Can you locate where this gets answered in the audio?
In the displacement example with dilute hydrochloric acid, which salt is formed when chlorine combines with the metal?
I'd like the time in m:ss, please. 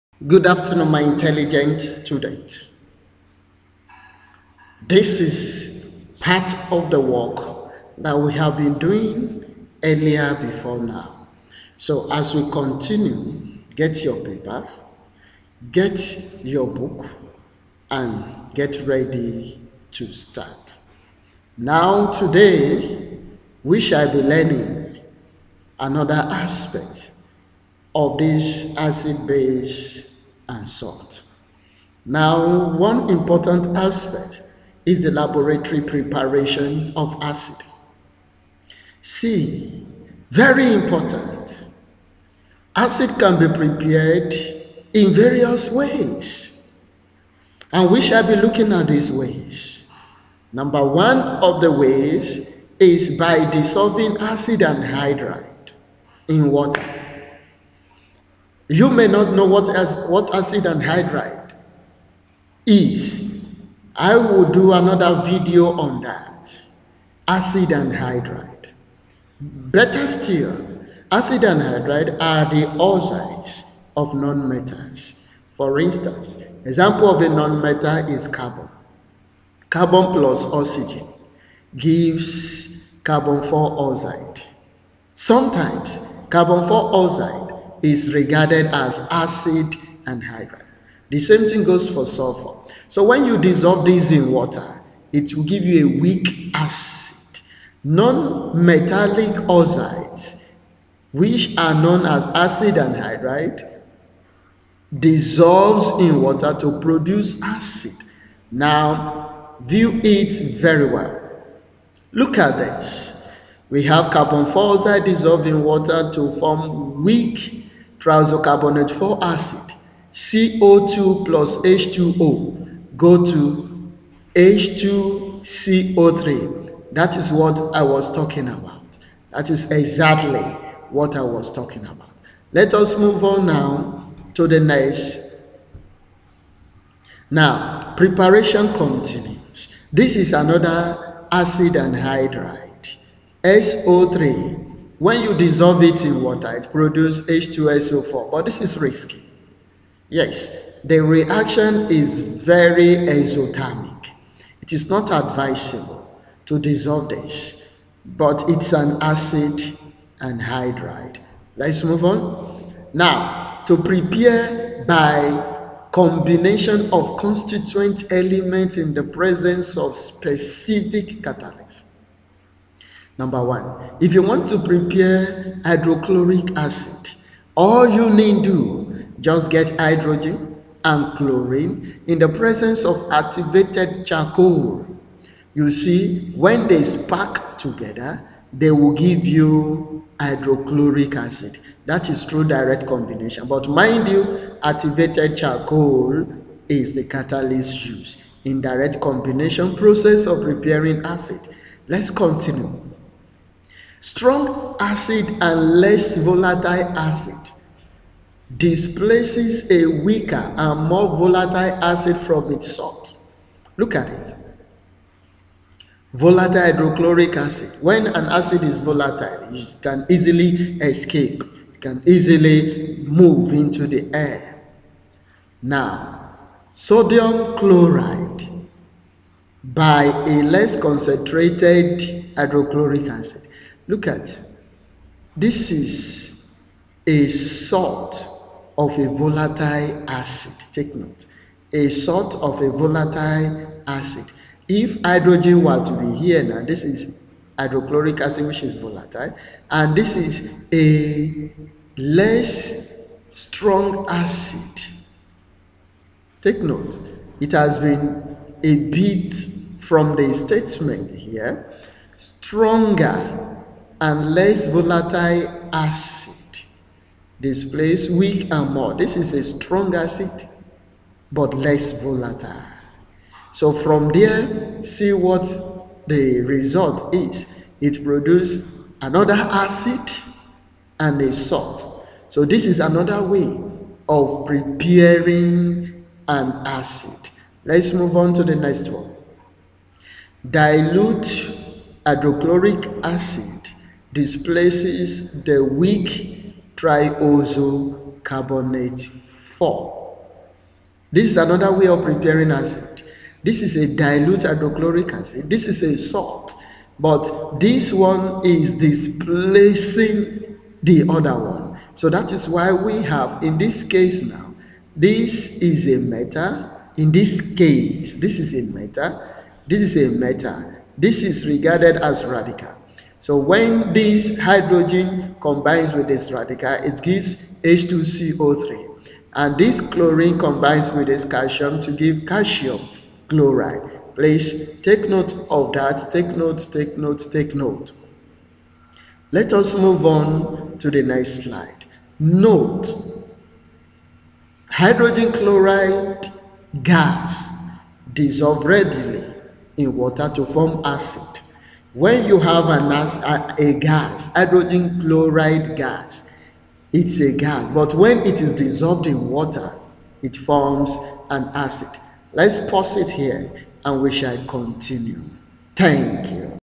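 5:32.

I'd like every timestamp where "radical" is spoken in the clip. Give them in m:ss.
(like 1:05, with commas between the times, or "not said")
5:22, 5:26.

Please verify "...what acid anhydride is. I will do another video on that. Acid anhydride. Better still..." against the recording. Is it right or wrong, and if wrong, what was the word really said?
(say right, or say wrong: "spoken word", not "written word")
right.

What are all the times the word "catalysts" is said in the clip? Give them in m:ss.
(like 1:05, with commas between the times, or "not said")
2:51, 3:17.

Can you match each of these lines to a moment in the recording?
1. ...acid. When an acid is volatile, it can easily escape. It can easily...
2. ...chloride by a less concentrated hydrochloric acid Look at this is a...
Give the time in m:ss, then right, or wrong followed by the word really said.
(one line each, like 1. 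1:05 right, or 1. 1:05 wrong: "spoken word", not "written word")
1. 3:37 right
2. 3:47 right.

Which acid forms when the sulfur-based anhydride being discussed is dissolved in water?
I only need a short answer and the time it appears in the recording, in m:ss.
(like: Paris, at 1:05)
H2SO4, at 2:27.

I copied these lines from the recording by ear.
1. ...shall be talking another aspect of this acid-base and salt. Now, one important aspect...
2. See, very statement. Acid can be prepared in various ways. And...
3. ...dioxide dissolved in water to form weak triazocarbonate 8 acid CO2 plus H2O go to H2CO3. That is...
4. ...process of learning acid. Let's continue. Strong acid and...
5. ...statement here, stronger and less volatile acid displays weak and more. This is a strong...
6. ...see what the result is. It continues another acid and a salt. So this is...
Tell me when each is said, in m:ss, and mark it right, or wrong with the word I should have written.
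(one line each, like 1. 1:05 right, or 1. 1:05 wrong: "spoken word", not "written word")
1. 0:23 wrong: "learning", not "talking"
2. 0:39 wrong: "important", not "statement"
3. 1:54 wrong: "4", not "8"
4. 3:19 wrong: "preparing", not "learning"
5. 4:20 right
6. 4:34 wrong: "produces", not "continues".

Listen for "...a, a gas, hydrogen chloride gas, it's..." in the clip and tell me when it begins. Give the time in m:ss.
5:52.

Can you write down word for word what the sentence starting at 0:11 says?
So as we continue, get your paper, get your book, and get ready to start.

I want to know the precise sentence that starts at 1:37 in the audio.
Non-metallic oxides, which are known as acid anhydride, dissolves in water to produce acid.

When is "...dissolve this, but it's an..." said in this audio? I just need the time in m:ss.
2:36.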